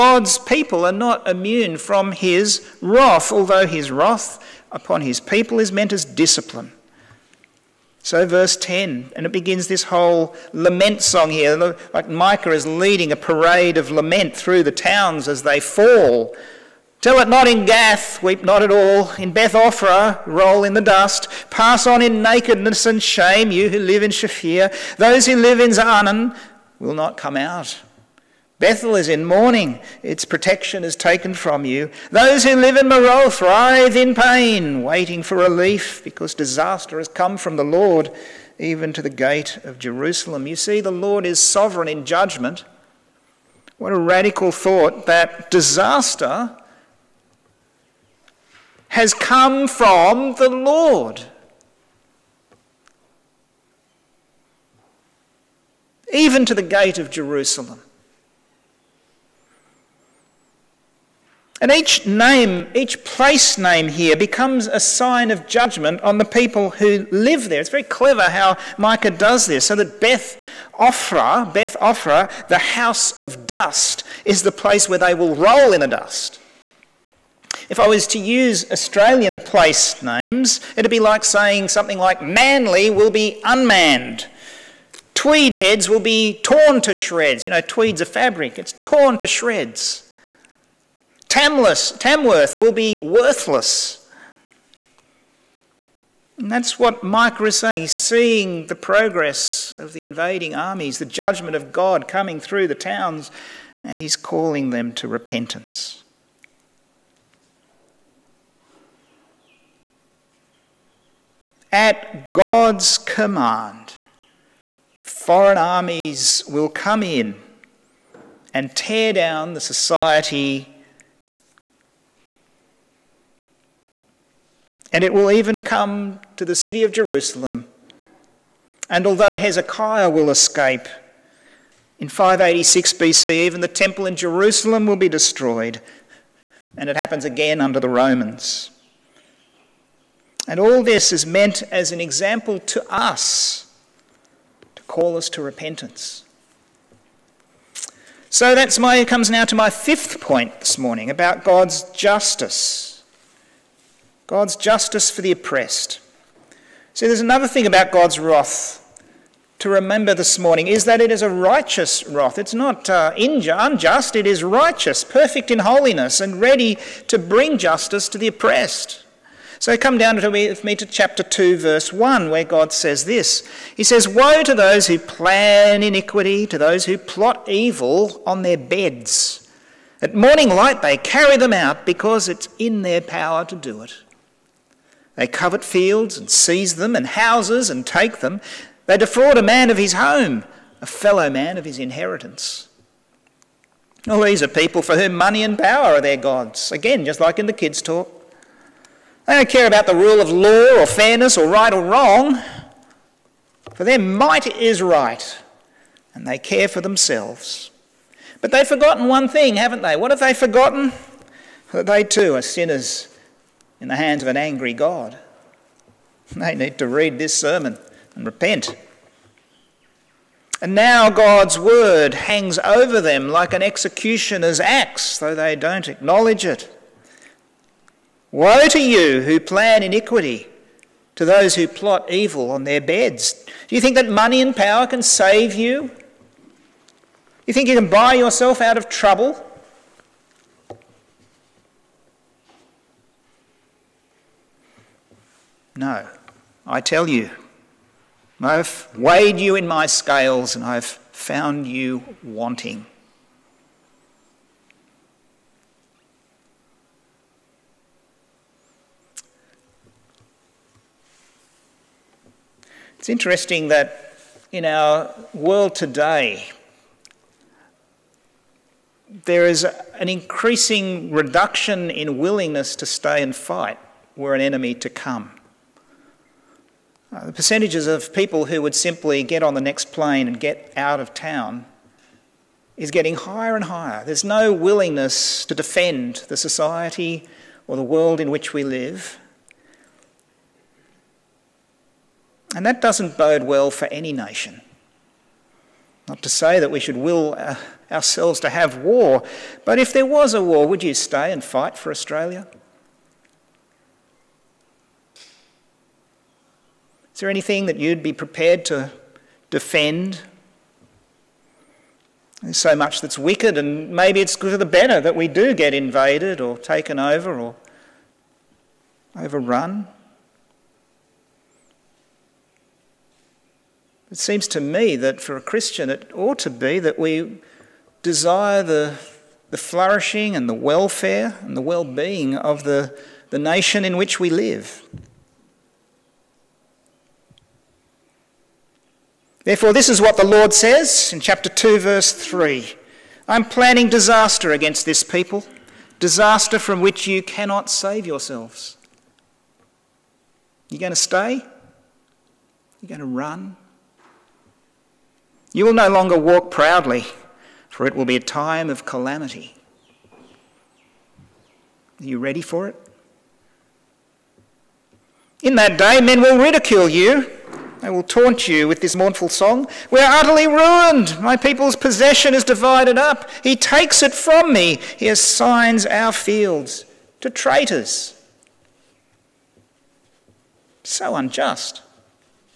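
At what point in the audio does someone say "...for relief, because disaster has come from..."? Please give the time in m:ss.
0:35.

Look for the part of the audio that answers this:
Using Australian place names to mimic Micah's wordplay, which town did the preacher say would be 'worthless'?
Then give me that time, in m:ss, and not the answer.
1:31.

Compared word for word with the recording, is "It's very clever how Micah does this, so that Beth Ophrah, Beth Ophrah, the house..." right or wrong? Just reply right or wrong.
right.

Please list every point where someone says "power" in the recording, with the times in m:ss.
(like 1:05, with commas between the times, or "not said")
3:03, 3:15, 3:54.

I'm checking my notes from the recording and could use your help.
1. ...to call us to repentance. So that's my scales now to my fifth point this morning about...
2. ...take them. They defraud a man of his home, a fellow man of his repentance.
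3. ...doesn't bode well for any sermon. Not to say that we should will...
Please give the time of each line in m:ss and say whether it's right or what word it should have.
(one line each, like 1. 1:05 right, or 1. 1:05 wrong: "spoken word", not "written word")
1. 2:24 wrong: "comes", not "scales"
2. 3:07 wrong: "inheritance", not "repentance"
3. 4:52 wrong: "nation", not "sermon".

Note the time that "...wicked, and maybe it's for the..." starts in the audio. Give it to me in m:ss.
5:13.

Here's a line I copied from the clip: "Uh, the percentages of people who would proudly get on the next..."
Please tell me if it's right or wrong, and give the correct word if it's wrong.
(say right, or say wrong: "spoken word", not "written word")
wrong: "simply", not "proudly".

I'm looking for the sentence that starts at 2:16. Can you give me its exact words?
And it happens again under the Romans.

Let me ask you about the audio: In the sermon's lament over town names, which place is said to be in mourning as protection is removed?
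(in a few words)
Bethel.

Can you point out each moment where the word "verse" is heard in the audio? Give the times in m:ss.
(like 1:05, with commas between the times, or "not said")
0:08, 2:51, 5:41.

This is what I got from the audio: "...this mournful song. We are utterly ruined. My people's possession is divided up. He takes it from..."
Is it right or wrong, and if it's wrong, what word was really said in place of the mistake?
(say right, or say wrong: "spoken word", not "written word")
right.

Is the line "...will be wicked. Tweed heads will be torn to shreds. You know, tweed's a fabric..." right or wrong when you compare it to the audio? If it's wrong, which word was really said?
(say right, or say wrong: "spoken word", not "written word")
wrong: "unmanned", not "wicked".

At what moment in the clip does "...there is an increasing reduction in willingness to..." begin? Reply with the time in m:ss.
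4:29.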